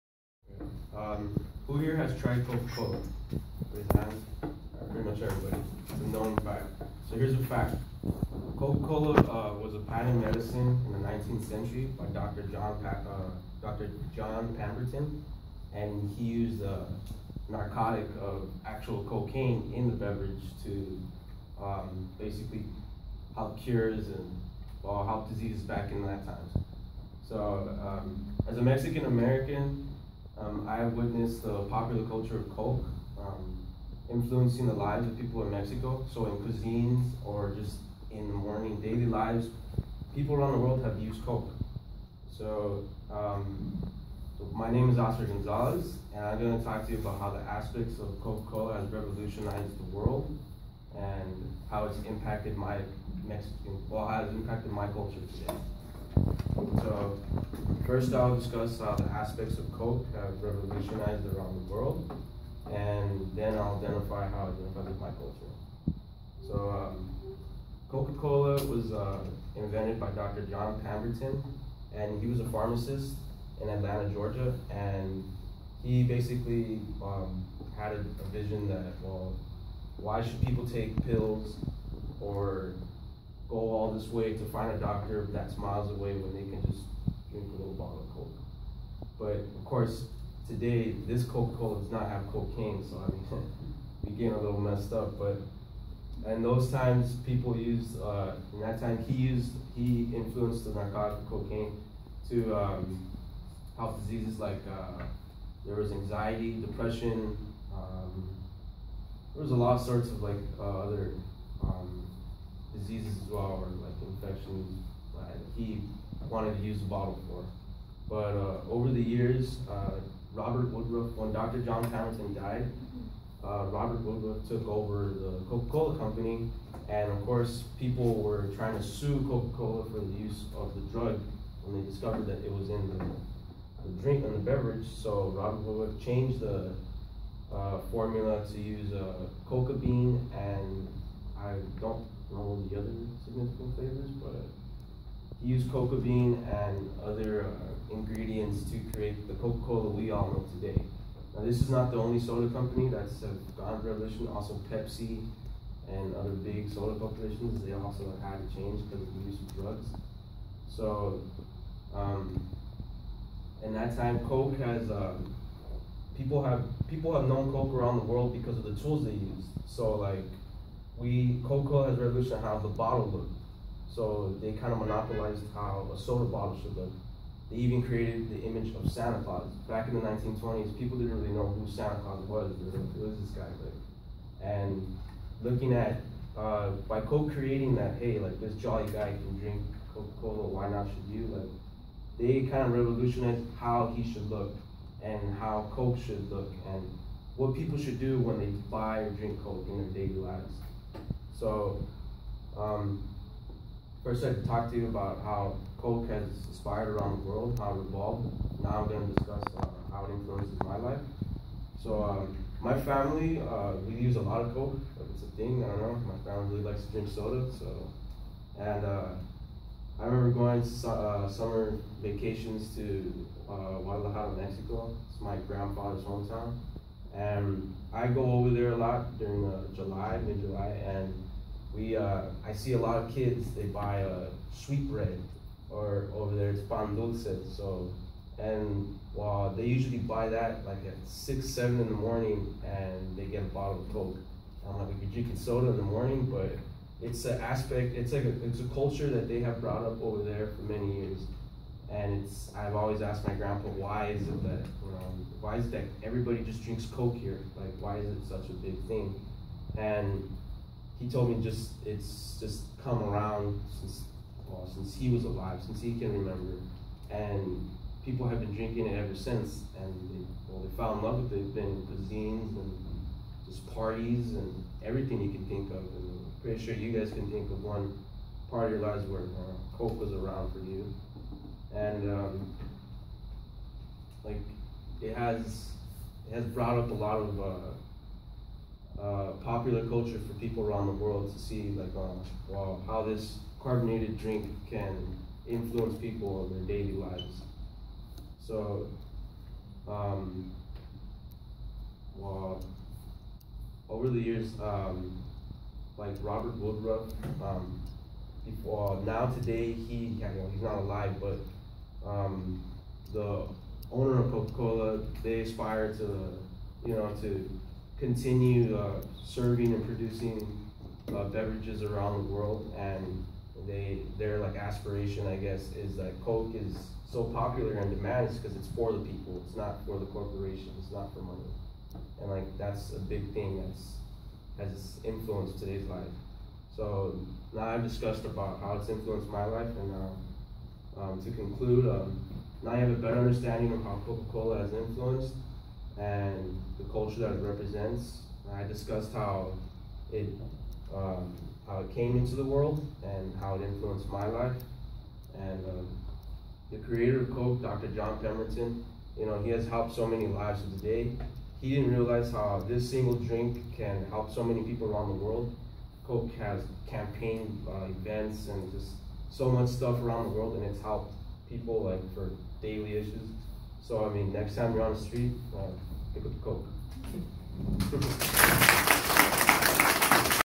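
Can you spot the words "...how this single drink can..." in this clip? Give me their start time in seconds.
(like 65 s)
362 s.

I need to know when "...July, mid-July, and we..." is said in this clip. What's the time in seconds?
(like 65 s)
229 s.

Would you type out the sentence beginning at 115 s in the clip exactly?
he wanted to use the bottle for.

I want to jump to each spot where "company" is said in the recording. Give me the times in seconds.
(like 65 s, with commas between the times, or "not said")
125 s, 152 s.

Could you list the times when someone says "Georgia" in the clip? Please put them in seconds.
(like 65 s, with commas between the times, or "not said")
74 s.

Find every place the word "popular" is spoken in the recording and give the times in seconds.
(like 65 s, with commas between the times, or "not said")
31 s, 289 s, 327 s.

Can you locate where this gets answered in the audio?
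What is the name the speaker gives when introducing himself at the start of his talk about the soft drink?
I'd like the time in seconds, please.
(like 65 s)
44 s.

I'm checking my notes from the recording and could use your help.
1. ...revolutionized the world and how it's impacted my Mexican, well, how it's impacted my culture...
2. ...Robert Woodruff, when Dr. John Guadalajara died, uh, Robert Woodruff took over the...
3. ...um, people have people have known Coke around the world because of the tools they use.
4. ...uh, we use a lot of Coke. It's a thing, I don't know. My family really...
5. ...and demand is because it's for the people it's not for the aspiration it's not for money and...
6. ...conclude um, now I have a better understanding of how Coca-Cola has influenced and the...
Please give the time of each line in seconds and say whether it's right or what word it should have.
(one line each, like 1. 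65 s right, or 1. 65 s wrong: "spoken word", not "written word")
1. 48 s right
2. 120 s wrong: "Hamilton", not "Guadalajara"
3. 164 s right
4. 213 s right
5. 327 s wrong: "corporation", not "aspiration"
6. 341 s right.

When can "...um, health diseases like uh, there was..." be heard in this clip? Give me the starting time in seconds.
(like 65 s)
102 s.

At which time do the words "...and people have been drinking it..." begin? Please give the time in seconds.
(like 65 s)
267 s.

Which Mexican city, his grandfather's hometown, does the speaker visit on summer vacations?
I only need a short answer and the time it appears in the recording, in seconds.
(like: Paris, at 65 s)
Guadalajara, at 223 s.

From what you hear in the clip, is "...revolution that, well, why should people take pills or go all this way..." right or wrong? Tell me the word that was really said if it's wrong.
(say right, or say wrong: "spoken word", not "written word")
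wrong: "vision", not "revolution".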